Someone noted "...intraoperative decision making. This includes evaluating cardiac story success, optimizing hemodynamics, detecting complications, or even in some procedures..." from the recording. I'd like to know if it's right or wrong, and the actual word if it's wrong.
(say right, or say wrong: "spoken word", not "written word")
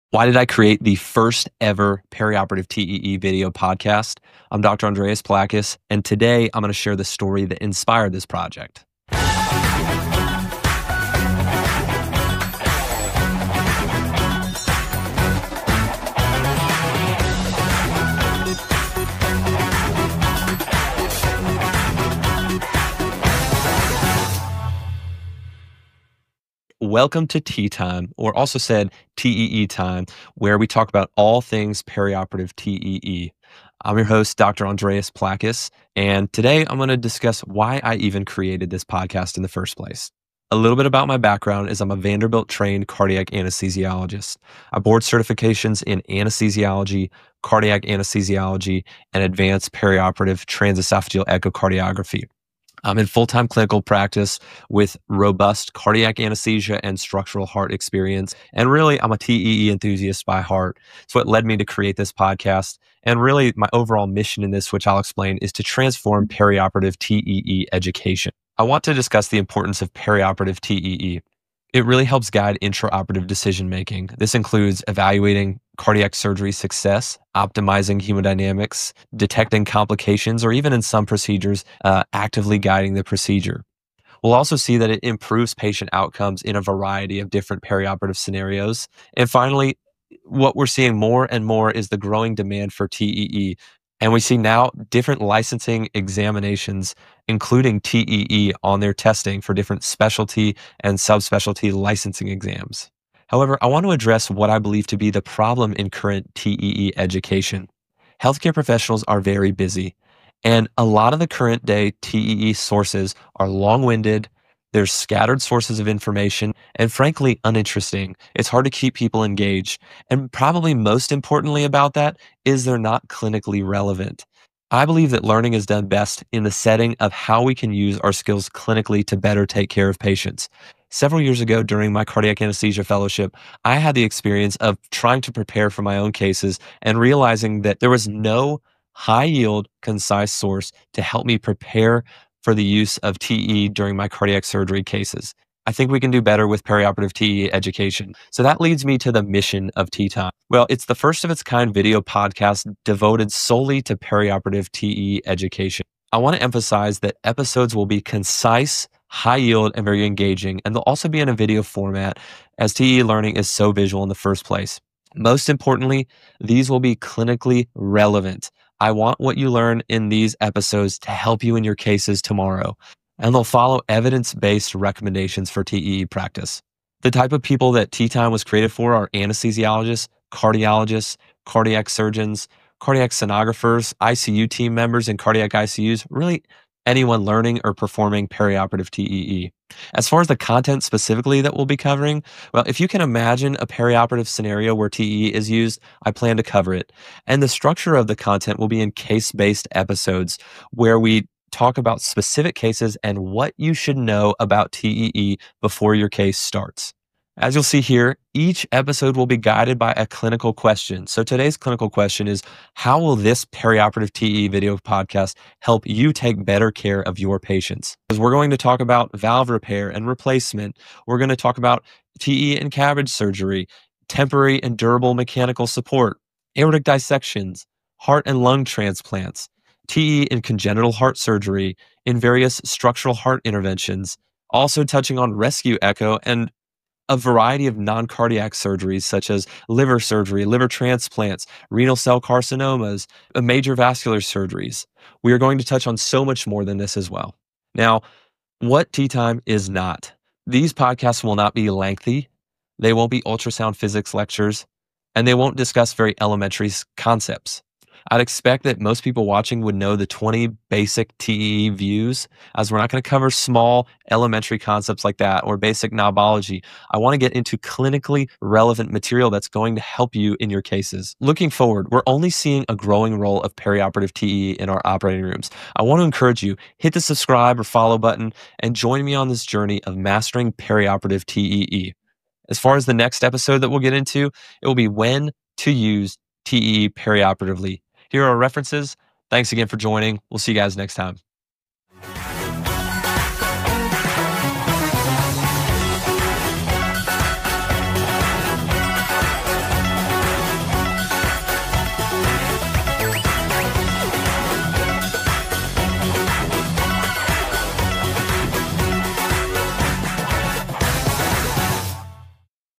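wrong: "surgery", not "story".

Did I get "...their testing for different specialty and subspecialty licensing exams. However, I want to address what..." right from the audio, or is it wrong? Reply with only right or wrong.
right.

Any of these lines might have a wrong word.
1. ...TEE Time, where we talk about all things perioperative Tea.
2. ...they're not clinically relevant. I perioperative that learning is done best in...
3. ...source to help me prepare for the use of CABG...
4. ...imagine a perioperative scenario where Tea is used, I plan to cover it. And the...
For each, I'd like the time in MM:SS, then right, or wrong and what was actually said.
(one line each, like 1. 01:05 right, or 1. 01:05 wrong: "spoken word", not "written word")
1. 00:29 wrong: "TEE", not "Tea"
2. 02:02 wrong: "believe", not "perioperative"
3. 02:20 wrong: "TEE", not "CABG"
4. 03:13 wrong: "TEE", not "Tea".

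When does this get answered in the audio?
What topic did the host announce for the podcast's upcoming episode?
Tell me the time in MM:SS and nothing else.
04:44.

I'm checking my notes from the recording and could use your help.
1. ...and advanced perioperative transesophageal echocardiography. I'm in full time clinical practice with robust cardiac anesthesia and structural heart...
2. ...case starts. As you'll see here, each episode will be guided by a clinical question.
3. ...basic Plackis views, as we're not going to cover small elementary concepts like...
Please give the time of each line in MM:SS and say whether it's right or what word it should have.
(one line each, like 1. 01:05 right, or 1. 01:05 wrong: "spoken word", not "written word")
1. 00:49 right
2. 03:26 right
3. 04:20 wrong: "TEE", not "Plackis".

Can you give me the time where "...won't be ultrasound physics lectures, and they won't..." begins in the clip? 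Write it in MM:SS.
04:12.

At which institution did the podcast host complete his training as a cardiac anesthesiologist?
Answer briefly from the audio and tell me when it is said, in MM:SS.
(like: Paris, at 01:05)
Vanderbilt, at 00:41.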